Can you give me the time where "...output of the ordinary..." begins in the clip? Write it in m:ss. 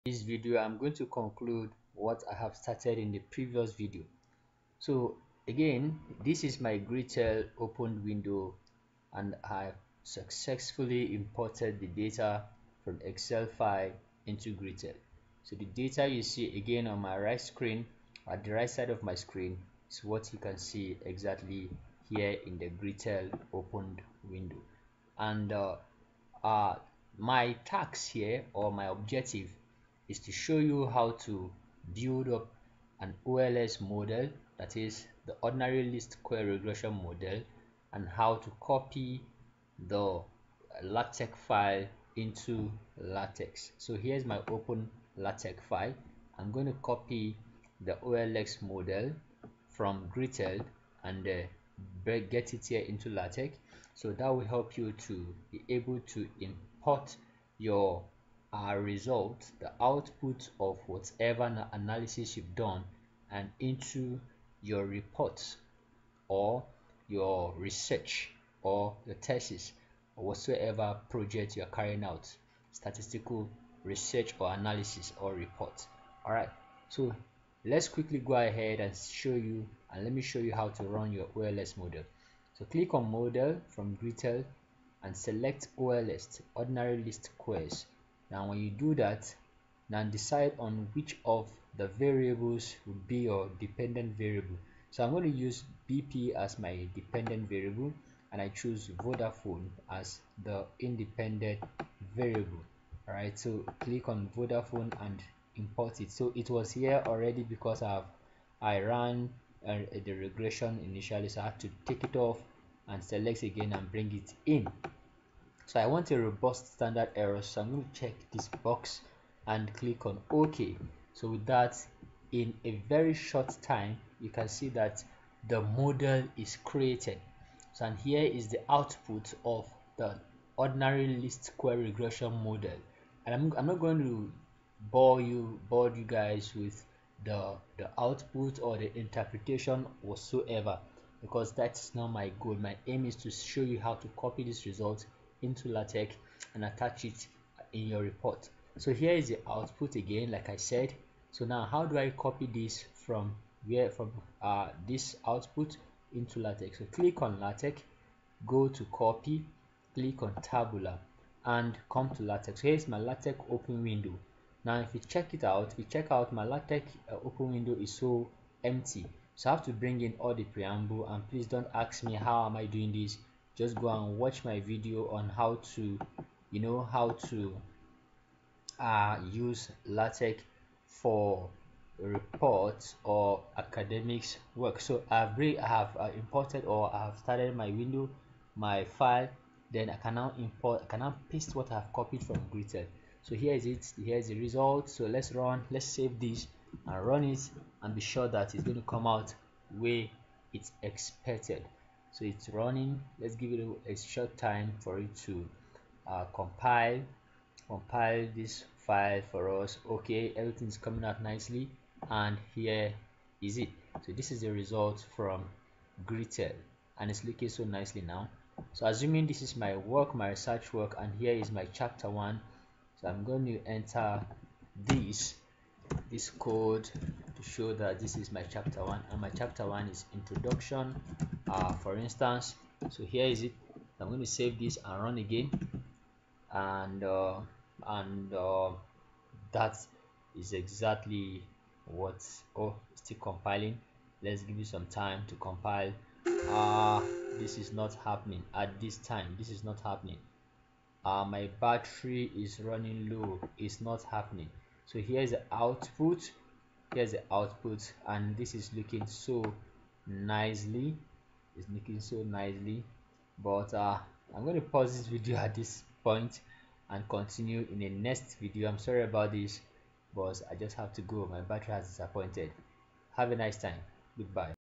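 2:08.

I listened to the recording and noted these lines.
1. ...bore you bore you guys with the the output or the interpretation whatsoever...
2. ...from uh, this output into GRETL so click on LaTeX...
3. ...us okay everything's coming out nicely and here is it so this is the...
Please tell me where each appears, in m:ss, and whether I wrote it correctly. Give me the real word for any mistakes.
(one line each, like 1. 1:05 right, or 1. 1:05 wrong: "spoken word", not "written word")
1. 2:14 right
2. 2:33 wrong: "LaTeX", not "GRETL"
3. 3:29 right.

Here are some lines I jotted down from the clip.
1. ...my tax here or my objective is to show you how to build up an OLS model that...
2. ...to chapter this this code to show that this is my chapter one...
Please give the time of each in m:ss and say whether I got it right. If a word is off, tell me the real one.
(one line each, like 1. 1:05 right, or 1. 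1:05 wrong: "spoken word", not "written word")
1. 0:27 right
2. 3:43 wrong: "enter", not "chapter".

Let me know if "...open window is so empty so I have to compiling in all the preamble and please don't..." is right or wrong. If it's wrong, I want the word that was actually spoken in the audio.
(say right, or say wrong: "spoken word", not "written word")
wrong: "bring", not "compiling".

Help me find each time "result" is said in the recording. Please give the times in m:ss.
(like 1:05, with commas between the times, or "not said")
0:58, 2:24, 3:14, 3:34.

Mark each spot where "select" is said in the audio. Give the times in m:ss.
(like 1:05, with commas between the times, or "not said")
1:25, 1:53.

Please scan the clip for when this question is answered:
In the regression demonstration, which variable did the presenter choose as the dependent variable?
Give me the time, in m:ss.
1:35.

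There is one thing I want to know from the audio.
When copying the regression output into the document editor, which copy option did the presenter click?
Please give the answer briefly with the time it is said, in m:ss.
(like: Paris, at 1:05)
tabula, at 2:40.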